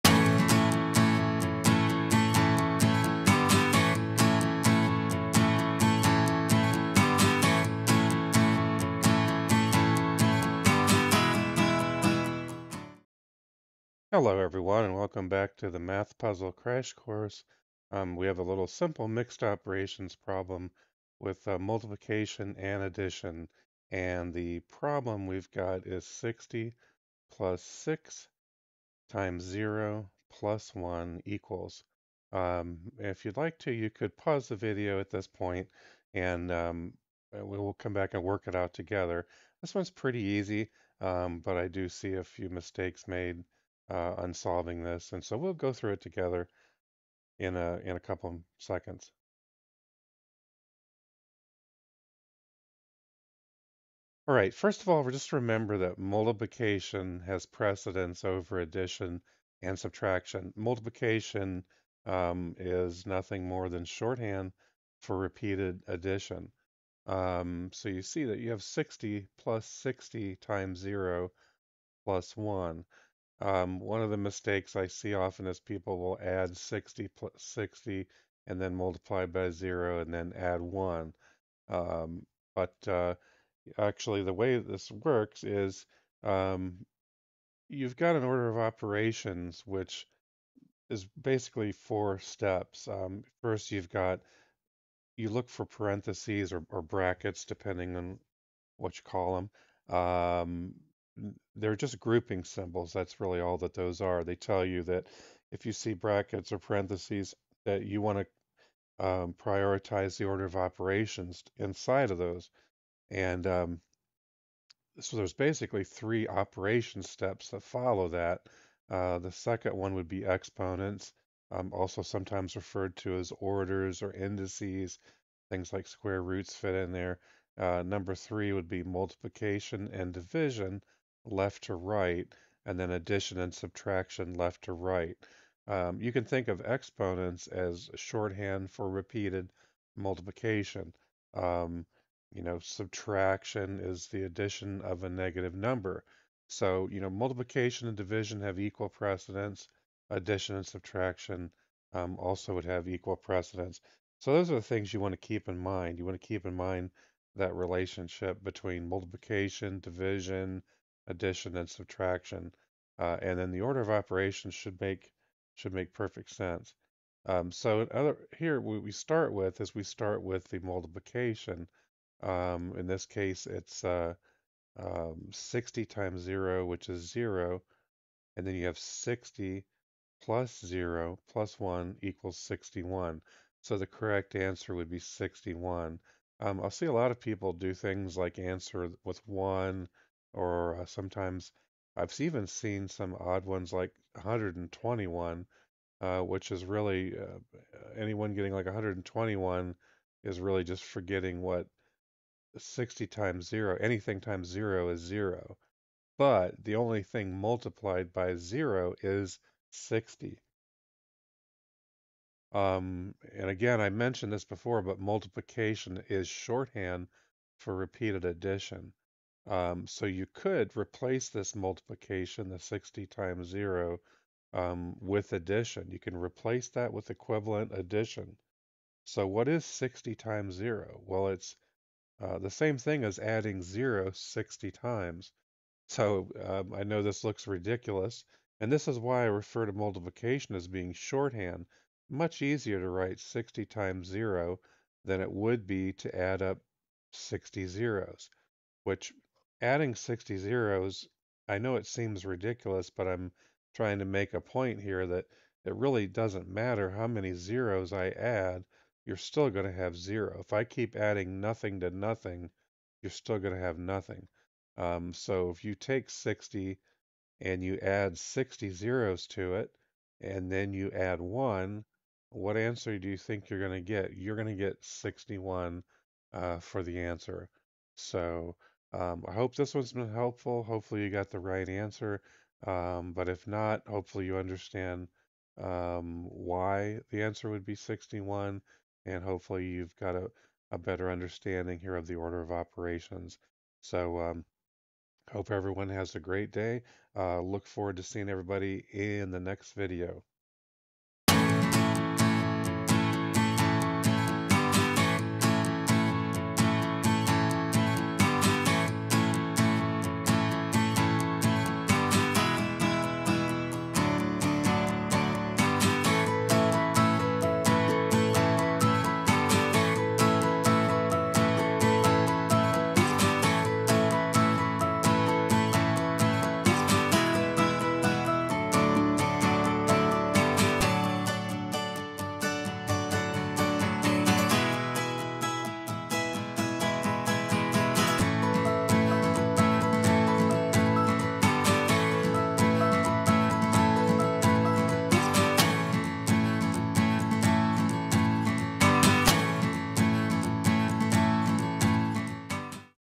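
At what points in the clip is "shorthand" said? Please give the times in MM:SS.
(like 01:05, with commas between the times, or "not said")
01:03, 02:17, 03:36, 04:00.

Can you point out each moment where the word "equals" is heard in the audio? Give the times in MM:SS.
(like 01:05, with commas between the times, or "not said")
00:31, 02:28, 02:32, 03:02.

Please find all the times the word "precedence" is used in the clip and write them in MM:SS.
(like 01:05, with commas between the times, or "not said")
00:57, 02:28, 02:33.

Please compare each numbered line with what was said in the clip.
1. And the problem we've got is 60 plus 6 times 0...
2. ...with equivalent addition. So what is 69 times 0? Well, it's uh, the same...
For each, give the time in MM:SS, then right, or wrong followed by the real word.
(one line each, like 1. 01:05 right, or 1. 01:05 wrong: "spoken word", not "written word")
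1. 00:23 right
2. 03:46 wrong: "60", not "69".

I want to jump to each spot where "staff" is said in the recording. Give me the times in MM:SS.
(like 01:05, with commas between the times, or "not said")
not said.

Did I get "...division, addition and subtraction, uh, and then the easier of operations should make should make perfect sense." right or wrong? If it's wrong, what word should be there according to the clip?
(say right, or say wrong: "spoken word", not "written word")
wrong: "order", not "easier".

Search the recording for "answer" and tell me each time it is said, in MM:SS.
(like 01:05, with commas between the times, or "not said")
03:04, 03:08, 04:32, 04:37, 04:41, 04:47.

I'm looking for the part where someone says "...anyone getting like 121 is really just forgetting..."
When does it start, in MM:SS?
03:17.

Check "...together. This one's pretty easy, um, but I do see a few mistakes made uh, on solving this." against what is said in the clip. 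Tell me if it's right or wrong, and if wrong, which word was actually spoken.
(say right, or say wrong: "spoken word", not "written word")
right.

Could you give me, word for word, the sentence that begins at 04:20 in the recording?
If I keep adding nothing to nothing, you're still going to have nothing.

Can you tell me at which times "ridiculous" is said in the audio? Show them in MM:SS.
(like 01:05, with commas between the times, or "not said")
03:57, 04:12.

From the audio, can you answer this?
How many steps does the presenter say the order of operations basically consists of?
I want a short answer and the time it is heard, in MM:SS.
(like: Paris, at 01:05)
4, at 01:31.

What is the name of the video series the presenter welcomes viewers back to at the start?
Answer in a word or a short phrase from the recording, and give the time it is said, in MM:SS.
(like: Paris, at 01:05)
Math Puzzle Crash Course, at 00:15.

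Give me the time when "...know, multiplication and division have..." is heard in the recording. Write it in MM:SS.
02:26.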